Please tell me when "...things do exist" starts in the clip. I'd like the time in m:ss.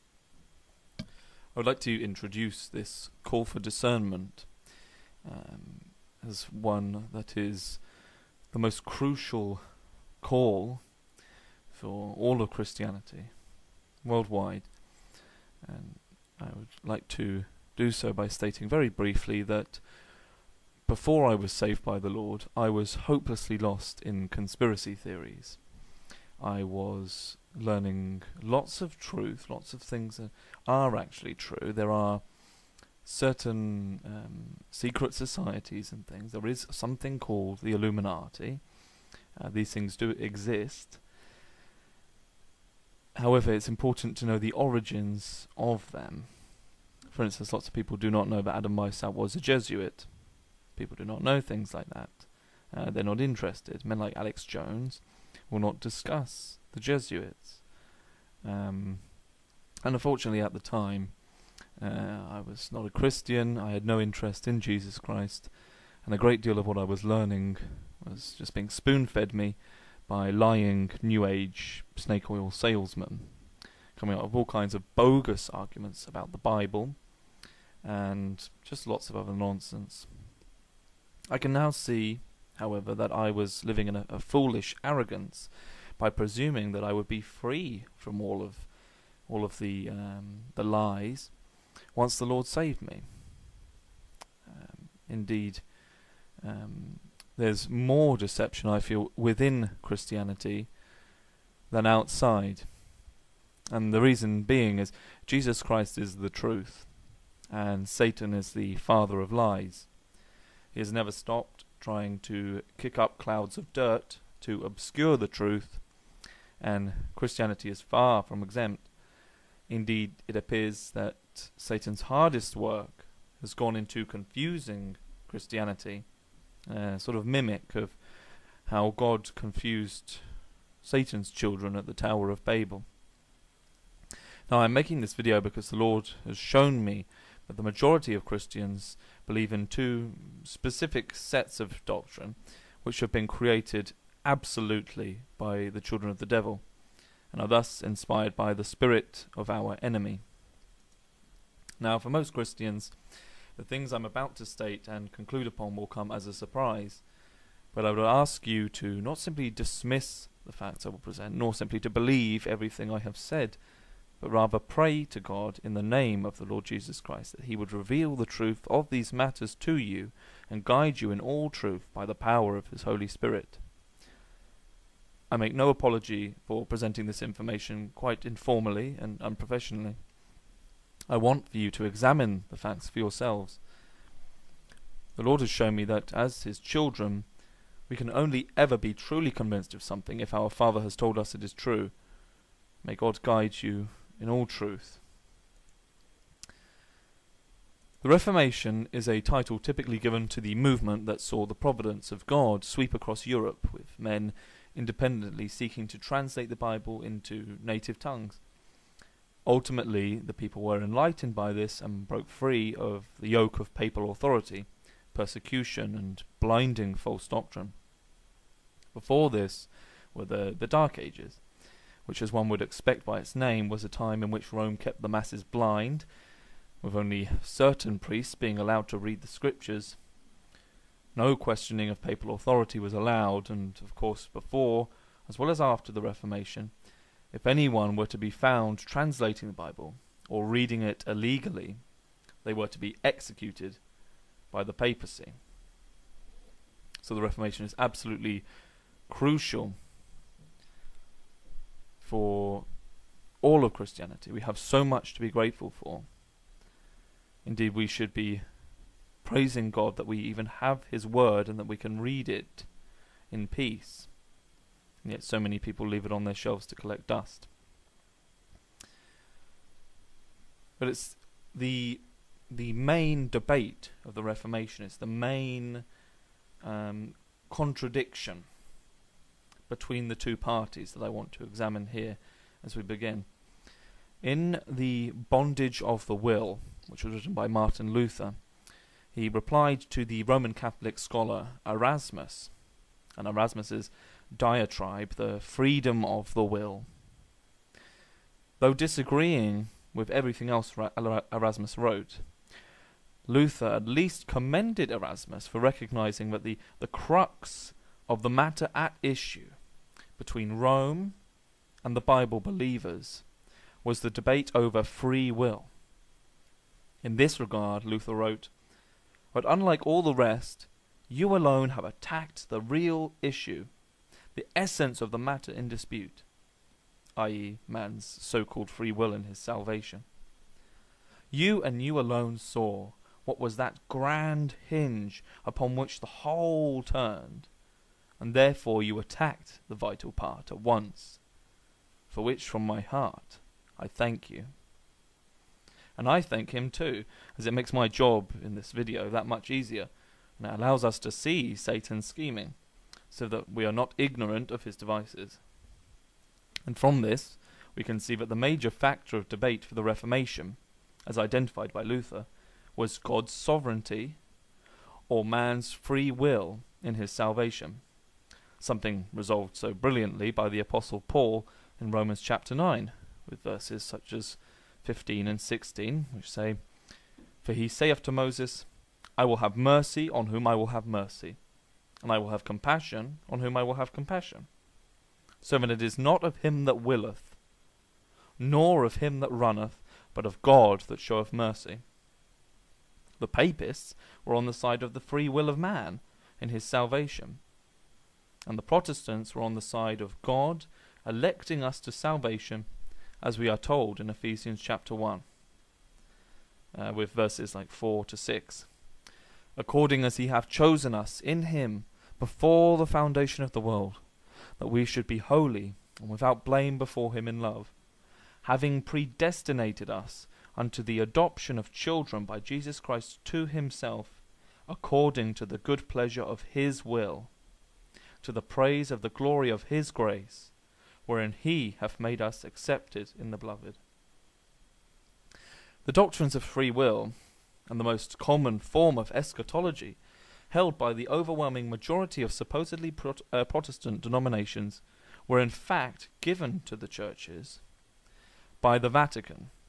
0:39.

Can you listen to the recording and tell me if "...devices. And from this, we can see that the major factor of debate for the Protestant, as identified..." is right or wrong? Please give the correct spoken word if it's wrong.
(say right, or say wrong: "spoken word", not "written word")
wrong: "Reformation", not "Protestant".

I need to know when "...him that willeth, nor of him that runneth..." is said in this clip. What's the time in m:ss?
6:26.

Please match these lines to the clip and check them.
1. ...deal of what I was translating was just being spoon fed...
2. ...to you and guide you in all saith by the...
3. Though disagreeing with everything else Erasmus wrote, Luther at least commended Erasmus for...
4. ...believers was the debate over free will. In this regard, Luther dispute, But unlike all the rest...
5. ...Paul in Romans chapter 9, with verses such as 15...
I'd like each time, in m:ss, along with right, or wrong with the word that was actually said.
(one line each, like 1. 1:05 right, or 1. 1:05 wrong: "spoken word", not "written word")
1. 1:06 wrong: "learning", not "translating"
2. 2:49 wrong: "truth", not "saith"
3. 4:58 right
4. 5:12 wrong: "wrote", not "dispute"
5. 6:11 right.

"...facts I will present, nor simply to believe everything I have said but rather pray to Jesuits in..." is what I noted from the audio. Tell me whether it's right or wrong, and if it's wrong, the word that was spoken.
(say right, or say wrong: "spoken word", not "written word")
wrong: "God", not "Jesuits".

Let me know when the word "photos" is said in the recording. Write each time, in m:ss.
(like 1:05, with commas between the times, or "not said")
not said.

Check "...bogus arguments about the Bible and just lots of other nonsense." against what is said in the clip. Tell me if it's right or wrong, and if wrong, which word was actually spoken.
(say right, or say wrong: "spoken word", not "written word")
right.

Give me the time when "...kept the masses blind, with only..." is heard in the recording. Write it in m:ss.
3:44.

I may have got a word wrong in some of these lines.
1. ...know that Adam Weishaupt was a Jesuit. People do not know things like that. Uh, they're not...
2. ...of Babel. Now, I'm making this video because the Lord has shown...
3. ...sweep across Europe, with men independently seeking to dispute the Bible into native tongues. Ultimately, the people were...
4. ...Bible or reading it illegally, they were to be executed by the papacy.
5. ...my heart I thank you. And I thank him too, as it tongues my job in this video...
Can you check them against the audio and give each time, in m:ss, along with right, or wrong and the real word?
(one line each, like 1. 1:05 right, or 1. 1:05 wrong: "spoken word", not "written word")
1. 0:48 right
2. 2:12 right
3. 3:22 wrong: "translate", not "dispute"
4. 3:59 right
5. 5:42 wrong: "makes", not "tongues".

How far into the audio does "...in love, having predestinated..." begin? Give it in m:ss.
6:57.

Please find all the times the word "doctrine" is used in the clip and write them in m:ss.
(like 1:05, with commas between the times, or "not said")
2:21, 3:37, 7:15.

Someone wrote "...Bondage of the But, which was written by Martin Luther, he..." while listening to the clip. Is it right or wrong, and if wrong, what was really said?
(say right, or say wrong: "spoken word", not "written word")
wrong: "Will", not "But".